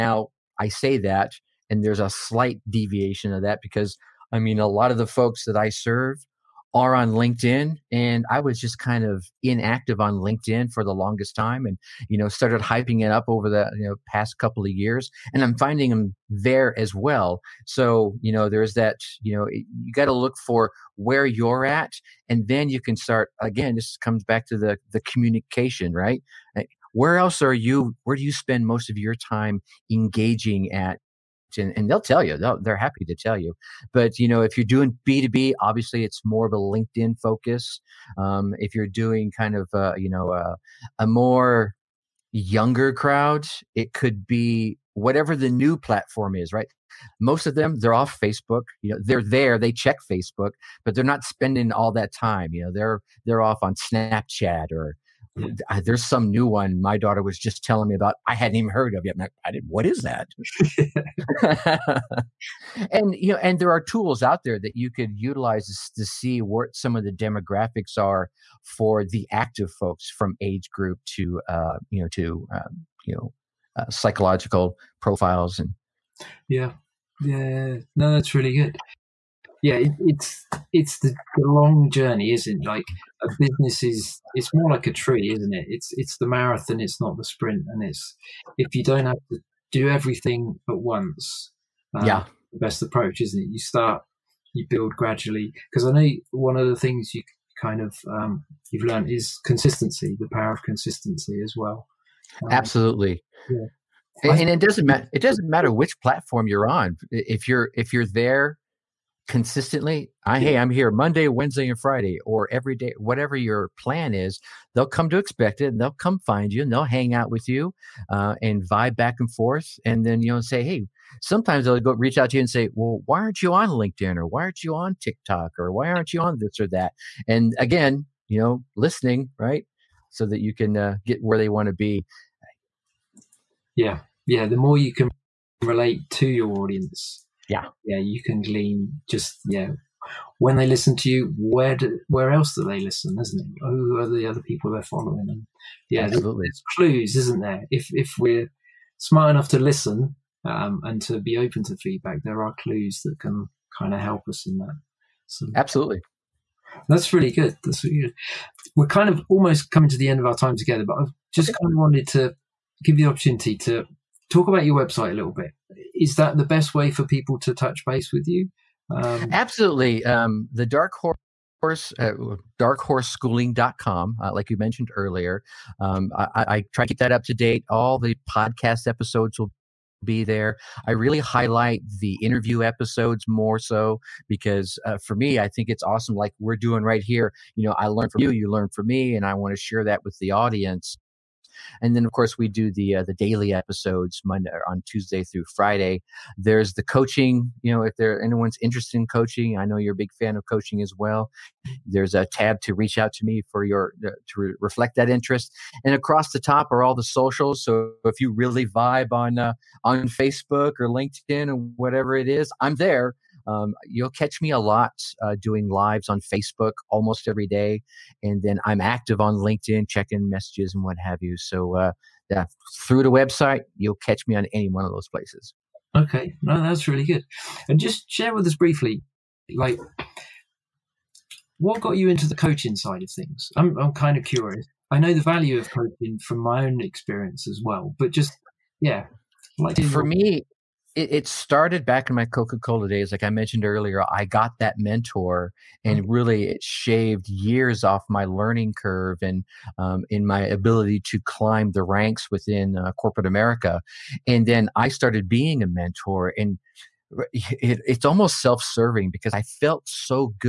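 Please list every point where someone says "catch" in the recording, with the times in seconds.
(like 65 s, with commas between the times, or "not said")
214 s, 223 s.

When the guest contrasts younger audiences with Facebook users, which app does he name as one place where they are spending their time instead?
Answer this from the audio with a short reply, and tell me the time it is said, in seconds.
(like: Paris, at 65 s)
Snapchat, at 53 s.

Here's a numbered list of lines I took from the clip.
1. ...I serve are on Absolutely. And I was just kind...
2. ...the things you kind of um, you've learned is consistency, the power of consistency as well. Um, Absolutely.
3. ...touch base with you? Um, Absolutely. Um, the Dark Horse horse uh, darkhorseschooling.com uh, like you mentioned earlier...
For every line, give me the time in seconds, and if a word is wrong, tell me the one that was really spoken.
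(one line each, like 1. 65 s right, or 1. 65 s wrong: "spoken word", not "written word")
1. 5 s wrong: "LinkedIn", not "Absolutely"
2. 96 s right
3. 167 s right.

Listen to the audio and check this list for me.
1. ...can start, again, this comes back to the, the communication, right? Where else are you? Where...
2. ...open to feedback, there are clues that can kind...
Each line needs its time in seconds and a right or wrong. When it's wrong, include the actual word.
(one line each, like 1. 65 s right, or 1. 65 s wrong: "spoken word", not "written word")
1. 22 s right
2. 151 s right.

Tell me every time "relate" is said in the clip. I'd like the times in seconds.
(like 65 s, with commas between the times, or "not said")
135 s.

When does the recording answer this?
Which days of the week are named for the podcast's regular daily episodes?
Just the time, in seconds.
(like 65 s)
194 s.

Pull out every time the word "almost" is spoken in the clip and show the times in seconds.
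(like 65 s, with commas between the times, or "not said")
159 s, 216 s, 258 s.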